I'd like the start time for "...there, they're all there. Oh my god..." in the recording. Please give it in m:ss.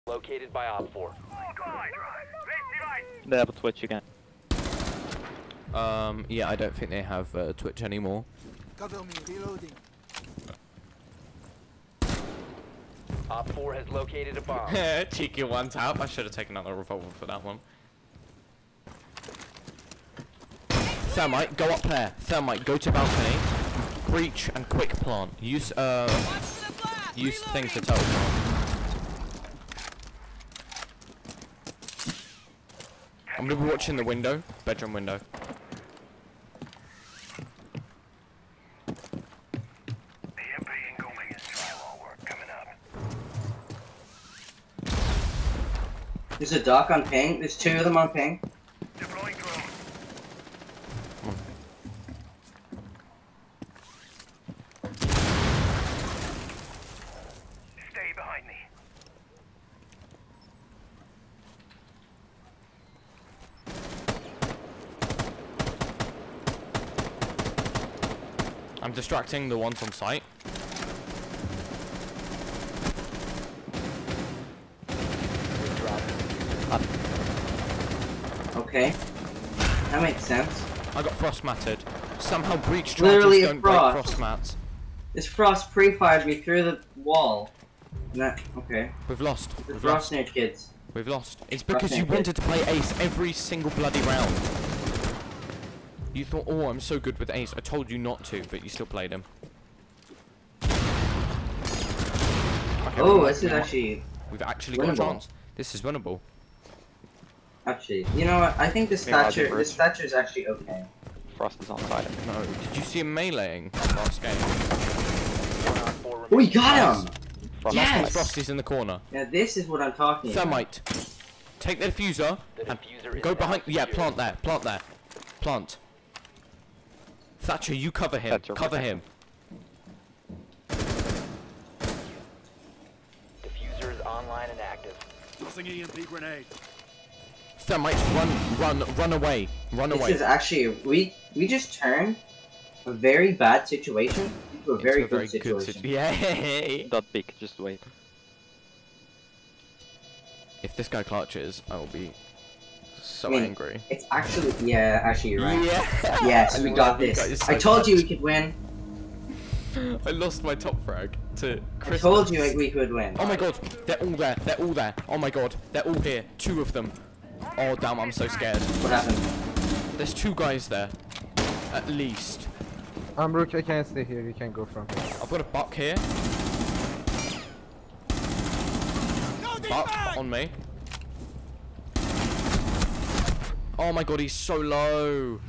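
2:44.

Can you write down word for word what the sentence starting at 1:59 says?
Yeah, this is what I'm talking Thermite.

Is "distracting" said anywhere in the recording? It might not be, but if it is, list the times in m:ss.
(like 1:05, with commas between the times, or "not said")
1:08.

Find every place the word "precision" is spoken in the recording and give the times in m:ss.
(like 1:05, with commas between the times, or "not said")
not said.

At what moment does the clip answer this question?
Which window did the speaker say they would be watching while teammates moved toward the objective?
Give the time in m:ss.
0:34.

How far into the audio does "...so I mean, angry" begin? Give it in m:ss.
2:32.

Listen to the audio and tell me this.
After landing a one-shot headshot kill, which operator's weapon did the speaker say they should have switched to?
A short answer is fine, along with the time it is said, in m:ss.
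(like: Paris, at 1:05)
revolver, at 0:16.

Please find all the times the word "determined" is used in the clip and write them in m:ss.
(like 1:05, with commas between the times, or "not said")
not said.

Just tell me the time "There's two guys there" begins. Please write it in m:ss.
2:49.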